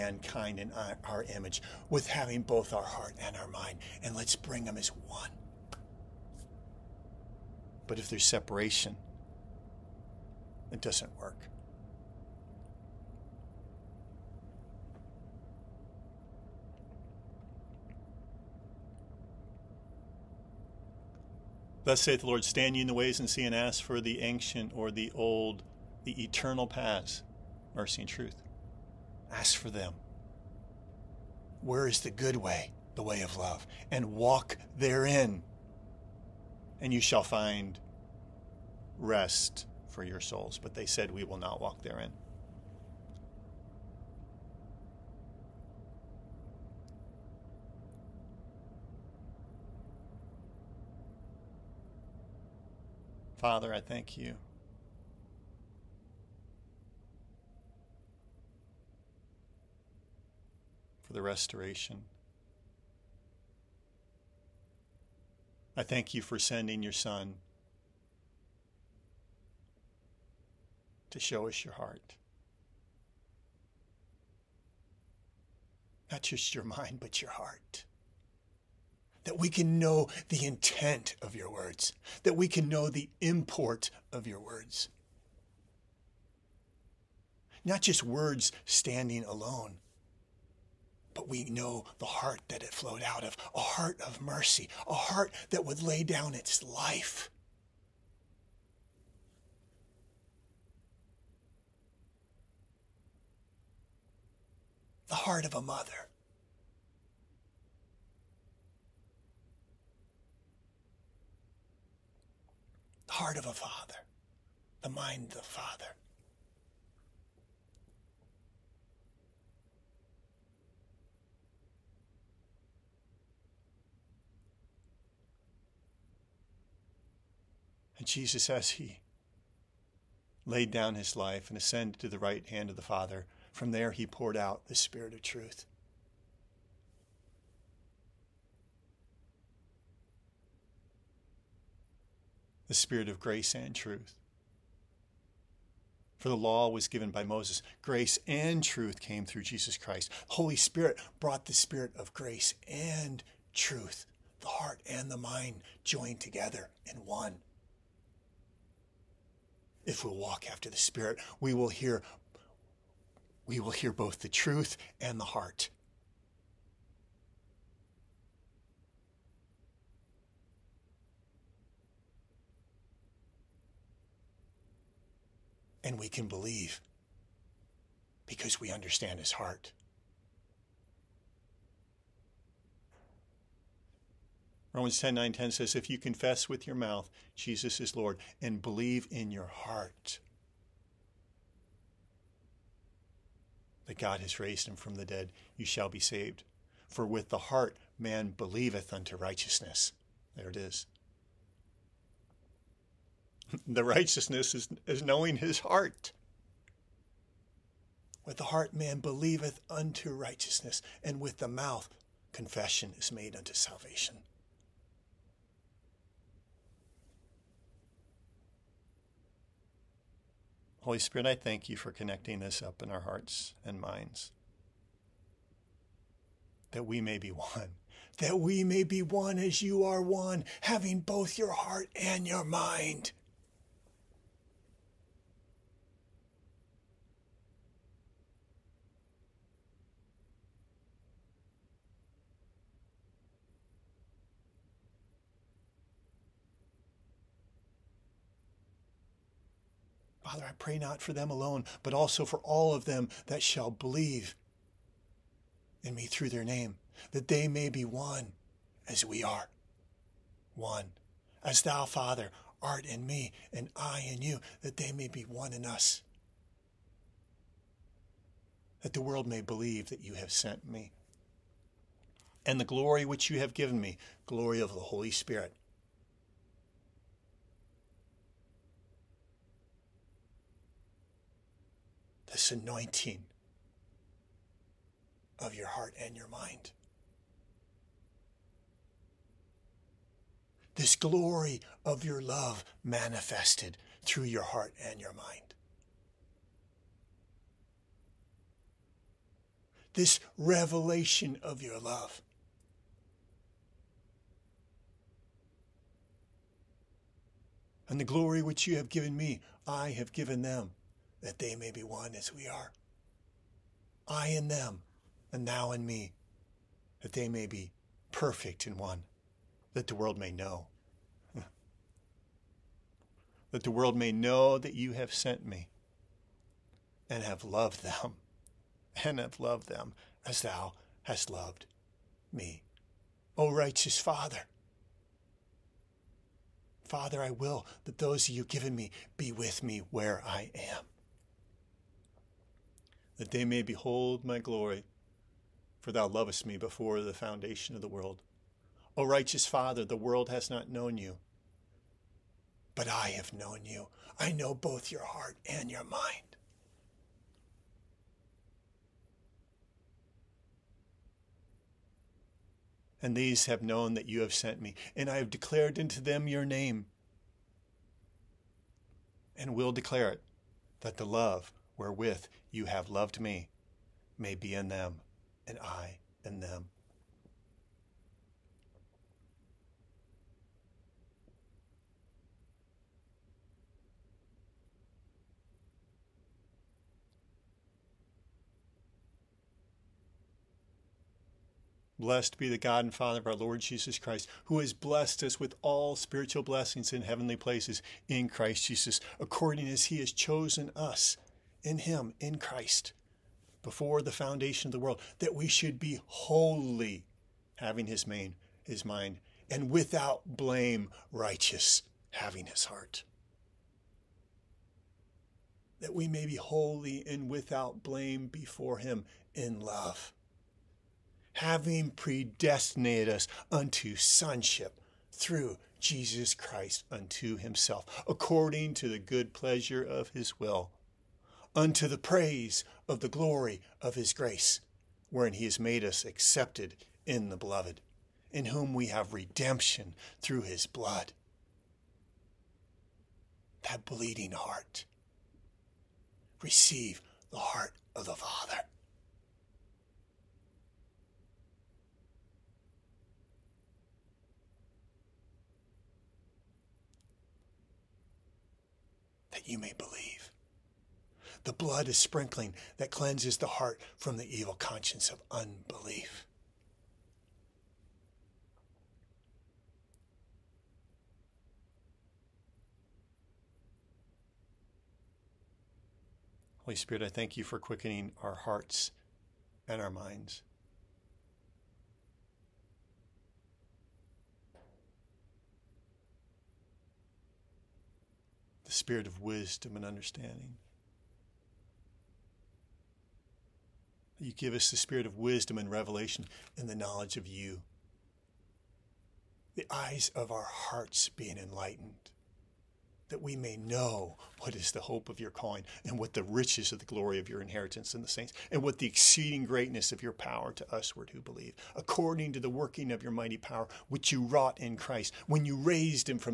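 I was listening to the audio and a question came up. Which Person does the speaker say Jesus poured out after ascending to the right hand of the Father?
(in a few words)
the Spirit of truth.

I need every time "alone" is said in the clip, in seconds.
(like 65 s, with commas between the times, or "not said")
89 s, 251 s.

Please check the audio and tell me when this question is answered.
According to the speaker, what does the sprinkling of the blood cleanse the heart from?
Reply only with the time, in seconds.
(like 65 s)
464 s.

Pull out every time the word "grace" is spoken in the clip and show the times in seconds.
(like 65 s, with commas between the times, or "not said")
143 s, 147 s, 152 s, 434 s.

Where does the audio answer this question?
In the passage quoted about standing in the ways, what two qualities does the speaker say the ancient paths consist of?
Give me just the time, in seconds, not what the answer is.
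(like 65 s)
27 s.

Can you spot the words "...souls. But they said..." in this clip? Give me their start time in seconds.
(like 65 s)
40 s.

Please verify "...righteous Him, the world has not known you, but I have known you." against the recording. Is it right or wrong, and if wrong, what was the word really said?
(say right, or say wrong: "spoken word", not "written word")
wrong: "Father", not "Him".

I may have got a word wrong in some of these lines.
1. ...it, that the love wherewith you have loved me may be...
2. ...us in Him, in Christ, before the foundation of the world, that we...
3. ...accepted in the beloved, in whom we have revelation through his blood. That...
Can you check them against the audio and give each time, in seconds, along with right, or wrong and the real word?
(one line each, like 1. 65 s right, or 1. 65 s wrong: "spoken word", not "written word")
1. 370 s right
2. 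400 s right
3. 436 s wrong: "redemption", not "revelation".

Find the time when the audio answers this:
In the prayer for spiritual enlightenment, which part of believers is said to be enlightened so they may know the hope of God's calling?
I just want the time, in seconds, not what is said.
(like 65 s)
499 s.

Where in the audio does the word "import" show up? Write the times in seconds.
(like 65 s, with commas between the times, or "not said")
83 s.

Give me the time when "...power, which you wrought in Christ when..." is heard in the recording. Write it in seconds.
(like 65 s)
513 s.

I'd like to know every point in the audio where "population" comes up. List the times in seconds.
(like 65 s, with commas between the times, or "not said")
not said.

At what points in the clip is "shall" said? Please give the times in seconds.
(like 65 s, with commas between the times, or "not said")
36 s, 195 s, 253 s.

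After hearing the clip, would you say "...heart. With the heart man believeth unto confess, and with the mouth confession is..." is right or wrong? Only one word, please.
wrong.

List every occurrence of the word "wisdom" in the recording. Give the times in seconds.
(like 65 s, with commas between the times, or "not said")
489 s, 495 s.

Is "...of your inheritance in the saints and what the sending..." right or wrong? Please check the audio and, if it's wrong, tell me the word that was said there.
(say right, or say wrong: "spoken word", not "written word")
wrong: "exceeding", not "sending".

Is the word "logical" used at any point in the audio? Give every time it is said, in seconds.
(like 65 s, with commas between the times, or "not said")
not said.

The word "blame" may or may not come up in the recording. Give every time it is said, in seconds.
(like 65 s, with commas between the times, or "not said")
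410 s, 417 s.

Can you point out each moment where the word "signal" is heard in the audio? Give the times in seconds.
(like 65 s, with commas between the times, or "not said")
not said.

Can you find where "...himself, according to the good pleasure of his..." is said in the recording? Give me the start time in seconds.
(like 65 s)
427 s.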